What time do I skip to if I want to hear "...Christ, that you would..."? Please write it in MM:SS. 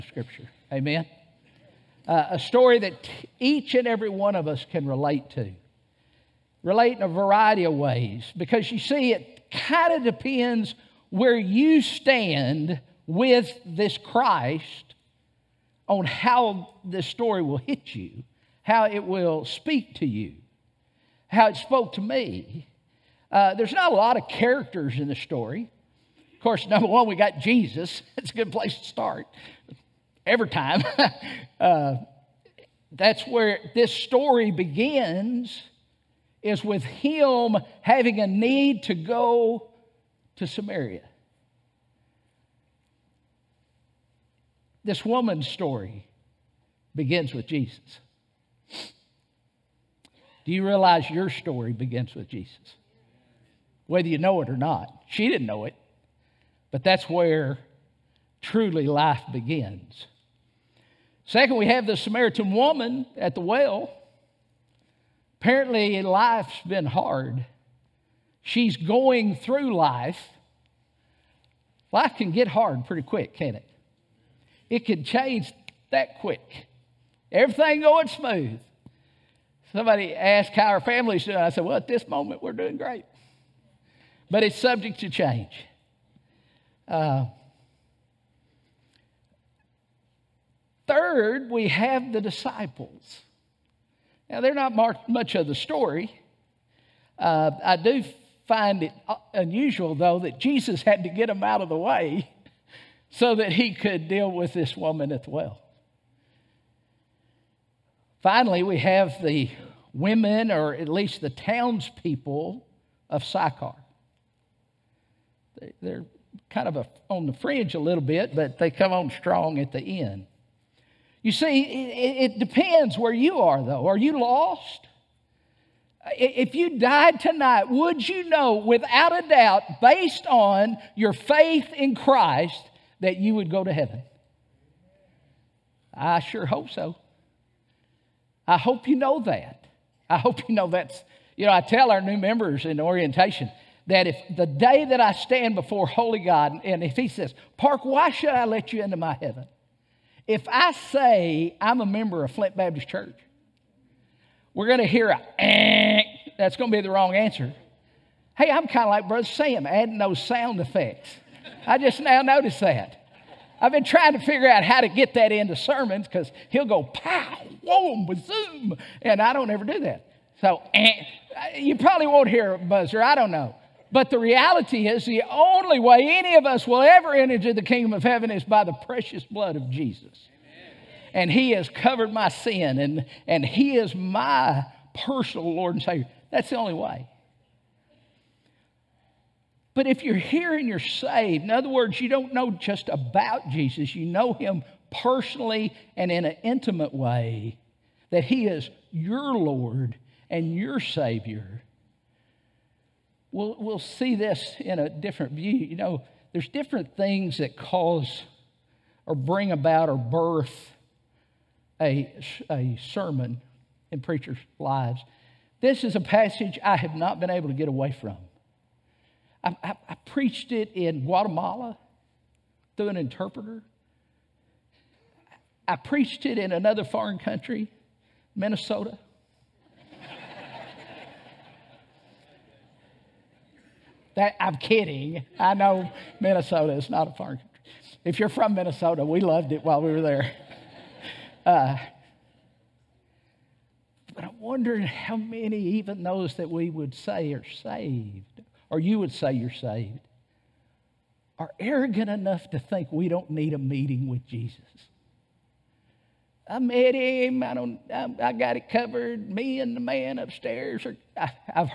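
02:11.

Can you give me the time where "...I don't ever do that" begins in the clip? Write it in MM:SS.
02:49.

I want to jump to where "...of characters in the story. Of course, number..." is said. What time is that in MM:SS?
00:24.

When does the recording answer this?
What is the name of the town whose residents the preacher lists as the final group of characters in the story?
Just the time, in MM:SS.
01:53.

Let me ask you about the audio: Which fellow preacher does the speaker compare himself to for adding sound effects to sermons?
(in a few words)
Brother Sam.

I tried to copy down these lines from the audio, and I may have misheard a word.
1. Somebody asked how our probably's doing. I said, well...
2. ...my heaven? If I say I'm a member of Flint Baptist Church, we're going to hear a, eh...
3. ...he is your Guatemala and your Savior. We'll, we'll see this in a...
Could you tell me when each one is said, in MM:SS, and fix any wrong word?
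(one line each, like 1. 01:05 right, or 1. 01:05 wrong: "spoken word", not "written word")
1. 01:19 wrong: "family", not "probably"
2. 02:28 right
3. 03:18 wrong: "Lord", not "Guatemala".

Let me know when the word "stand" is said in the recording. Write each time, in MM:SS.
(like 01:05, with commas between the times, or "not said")
00:11, 02:25.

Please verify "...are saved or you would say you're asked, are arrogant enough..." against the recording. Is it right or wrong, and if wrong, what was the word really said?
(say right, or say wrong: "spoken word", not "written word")
wrong: "saved", not "asked".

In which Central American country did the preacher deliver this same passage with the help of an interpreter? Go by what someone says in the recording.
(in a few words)
Guatemala.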